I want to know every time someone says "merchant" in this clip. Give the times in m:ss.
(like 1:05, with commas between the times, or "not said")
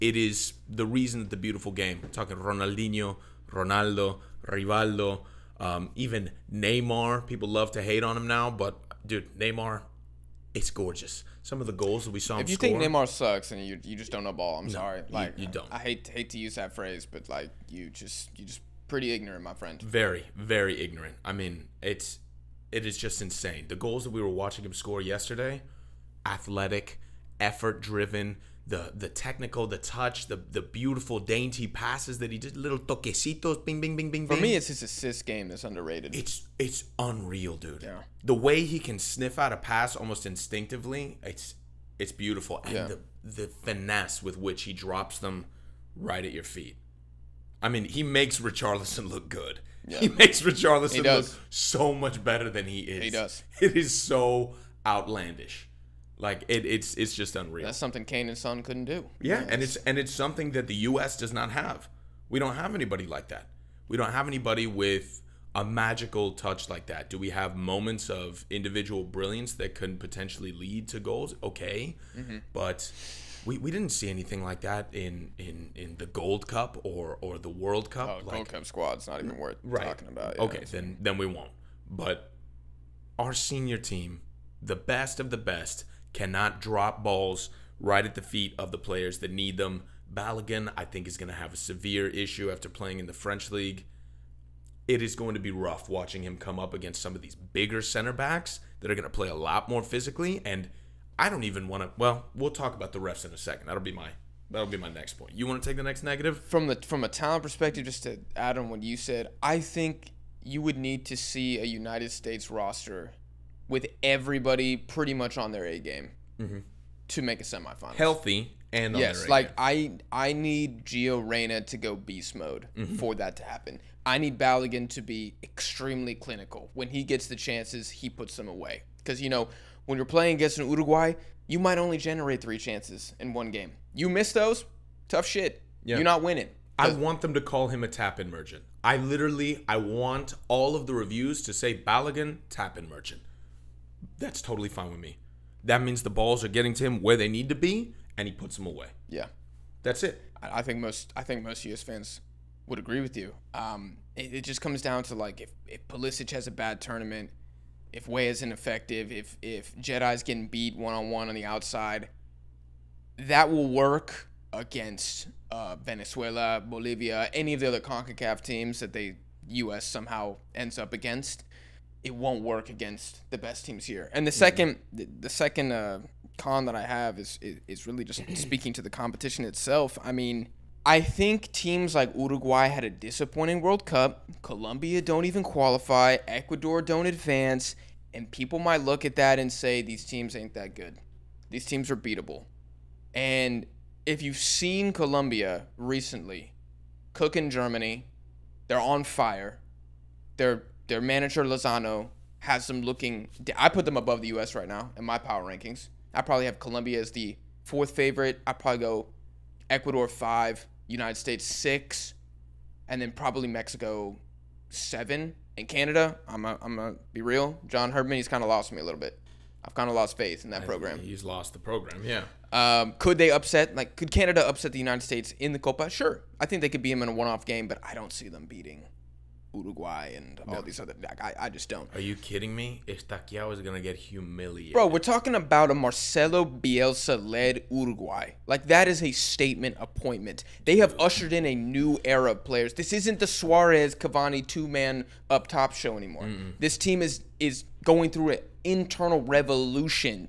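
2:18, 2:22.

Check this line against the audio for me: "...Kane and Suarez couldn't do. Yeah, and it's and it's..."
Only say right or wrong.
wrong.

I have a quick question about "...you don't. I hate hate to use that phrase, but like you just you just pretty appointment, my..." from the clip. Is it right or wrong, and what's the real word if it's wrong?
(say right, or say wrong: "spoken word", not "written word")
wrong: "ignorant", not "appointment".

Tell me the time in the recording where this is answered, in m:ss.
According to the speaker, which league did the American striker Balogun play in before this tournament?
1:33.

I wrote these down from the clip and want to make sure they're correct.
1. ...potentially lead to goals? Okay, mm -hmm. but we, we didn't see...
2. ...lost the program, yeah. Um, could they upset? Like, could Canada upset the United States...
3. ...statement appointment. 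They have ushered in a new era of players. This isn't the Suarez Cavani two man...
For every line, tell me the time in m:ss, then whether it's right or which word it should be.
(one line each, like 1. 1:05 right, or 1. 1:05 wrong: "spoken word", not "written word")
1. 1:09 right
2. 3:41 right
3. 3:59 right.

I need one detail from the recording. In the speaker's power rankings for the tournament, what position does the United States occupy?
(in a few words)
6.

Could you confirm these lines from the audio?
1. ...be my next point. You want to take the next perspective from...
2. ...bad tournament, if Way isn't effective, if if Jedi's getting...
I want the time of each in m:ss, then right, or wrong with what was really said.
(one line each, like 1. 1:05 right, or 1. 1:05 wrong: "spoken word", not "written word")
1. 1:44 wrong: "negative", not "perspective"
2. 2:36 right.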